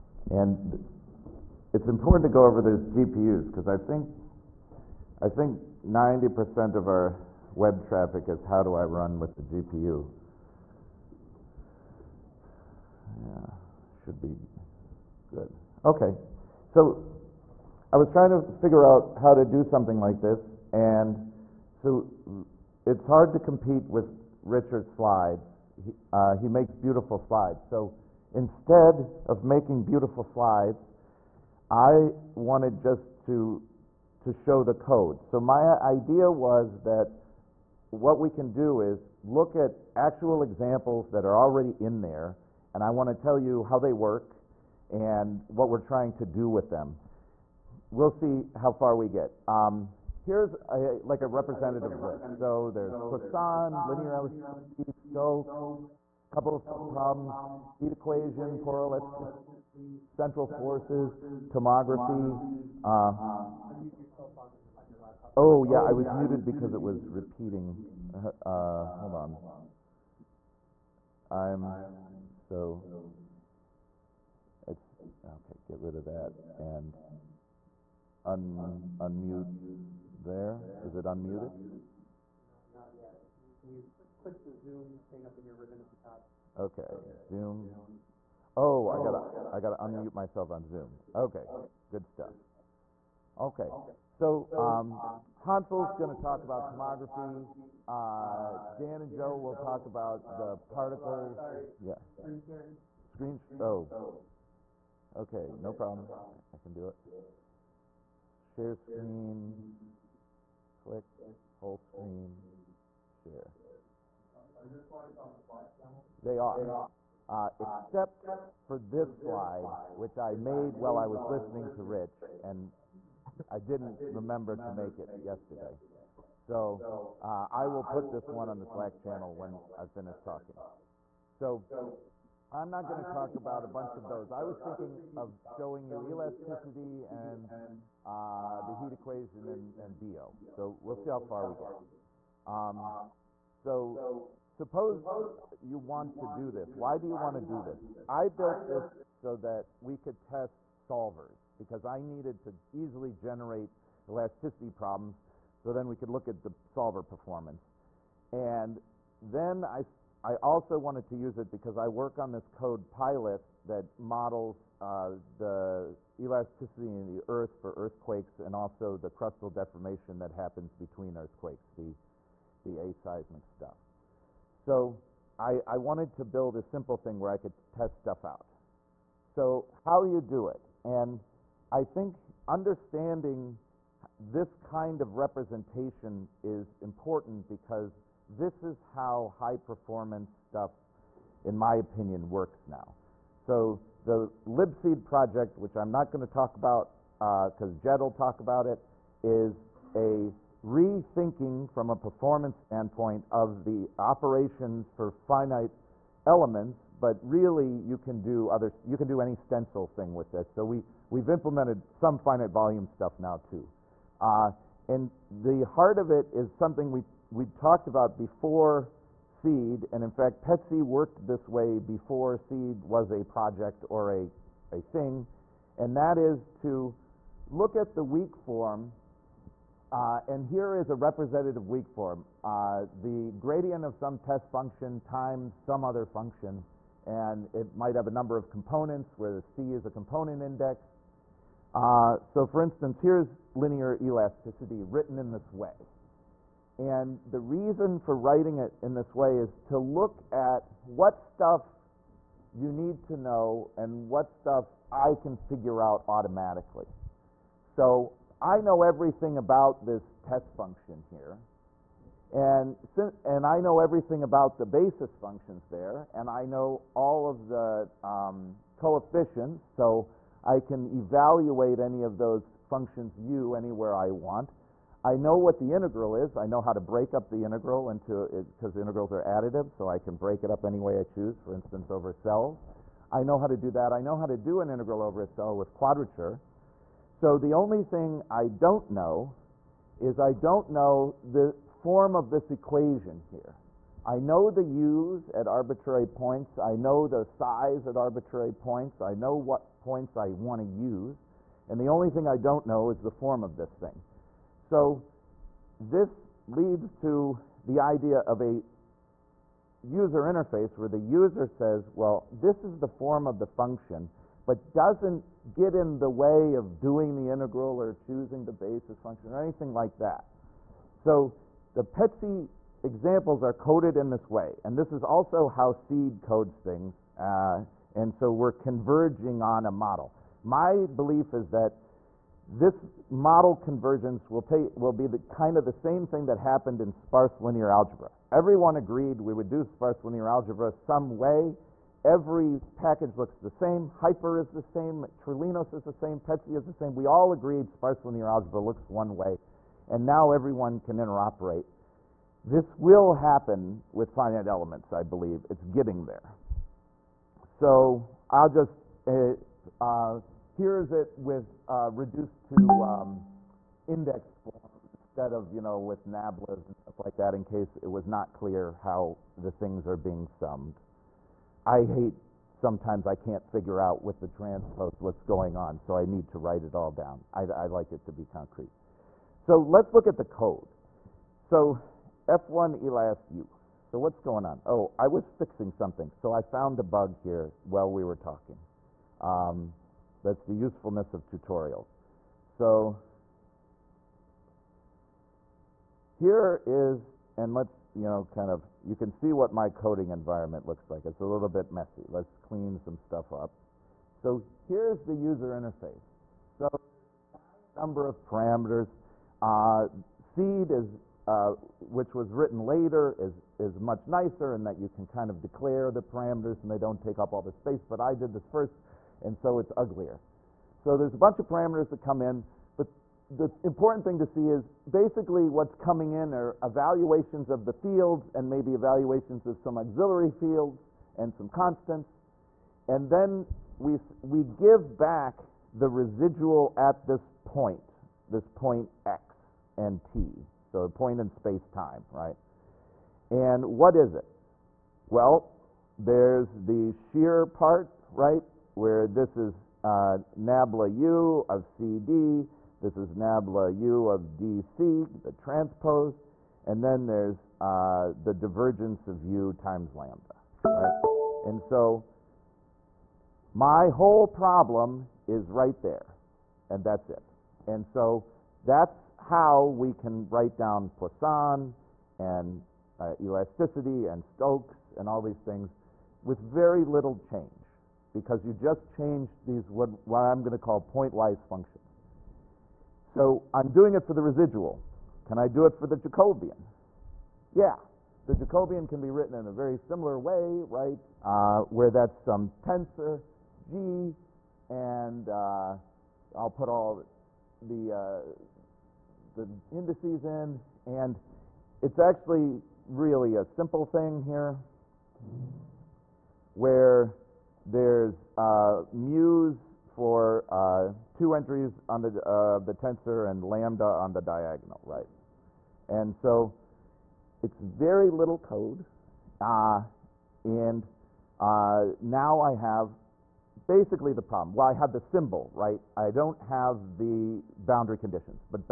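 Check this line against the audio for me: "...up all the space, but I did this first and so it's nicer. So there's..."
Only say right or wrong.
wrong.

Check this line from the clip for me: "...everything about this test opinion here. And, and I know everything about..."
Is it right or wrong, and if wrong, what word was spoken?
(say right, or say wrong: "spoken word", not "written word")
wrong: "function", not "opinion".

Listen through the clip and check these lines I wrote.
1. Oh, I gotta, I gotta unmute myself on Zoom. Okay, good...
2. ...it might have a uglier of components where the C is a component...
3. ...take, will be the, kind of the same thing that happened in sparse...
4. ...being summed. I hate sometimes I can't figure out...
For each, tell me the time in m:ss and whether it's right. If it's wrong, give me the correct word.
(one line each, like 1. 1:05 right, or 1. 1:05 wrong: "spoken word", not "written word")
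1. 1:28 right
2. 3:57 wrong: "number", not "uglier"
3. 5:34 right
4. 6:09 right.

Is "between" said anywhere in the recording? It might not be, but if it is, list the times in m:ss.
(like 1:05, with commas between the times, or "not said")
2:50.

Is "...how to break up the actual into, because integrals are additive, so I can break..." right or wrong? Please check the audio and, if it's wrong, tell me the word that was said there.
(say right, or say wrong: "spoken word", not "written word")
wrong: "integral", not "actual".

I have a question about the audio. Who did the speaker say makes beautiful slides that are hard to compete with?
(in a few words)
Richard.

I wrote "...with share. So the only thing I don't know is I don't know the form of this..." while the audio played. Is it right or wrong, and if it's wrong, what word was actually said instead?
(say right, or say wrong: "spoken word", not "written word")
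wrong: "quadrature", not "share".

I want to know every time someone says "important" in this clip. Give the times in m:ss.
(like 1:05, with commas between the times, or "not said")
0:01, 3:06, 7:03.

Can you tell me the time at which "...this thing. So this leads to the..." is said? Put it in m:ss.
5:03.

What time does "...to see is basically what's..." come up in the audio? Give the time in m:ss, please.
7:04.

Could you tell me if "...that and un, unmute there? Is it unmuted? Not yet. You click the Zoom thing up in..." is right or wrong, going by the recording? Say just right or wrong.
right.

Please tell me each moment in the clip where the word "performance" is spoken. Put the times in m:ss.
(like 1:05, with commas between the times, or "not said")
2:37, 3:09, 3:21.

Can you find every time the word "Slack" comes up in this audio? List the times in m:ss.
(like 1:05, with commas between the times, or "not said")
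2:08.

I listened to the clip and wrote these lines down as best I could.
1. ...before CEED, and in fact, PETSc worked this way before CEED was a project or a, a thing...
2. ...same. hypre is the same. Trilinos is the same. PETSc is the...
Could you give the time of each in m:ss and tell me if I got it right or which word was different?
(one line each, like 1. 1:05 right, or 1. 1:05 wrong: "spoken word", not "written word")
1. 3:38 right
2. 5:43 right.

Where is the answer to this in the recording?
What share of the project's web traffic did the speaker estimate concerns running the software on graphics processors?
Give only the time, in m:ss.
0:05.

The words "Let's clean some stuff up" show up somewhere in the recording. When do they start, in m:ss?
6:42.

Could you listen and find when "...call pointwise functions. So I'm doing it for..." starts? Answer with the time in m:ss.
8:00.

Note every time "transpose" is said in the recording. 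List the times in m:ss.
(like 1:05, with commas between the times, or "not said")
6:14, 7:35.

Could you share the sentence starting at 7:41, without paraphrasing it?
And so my whole problem is right there, and that's it.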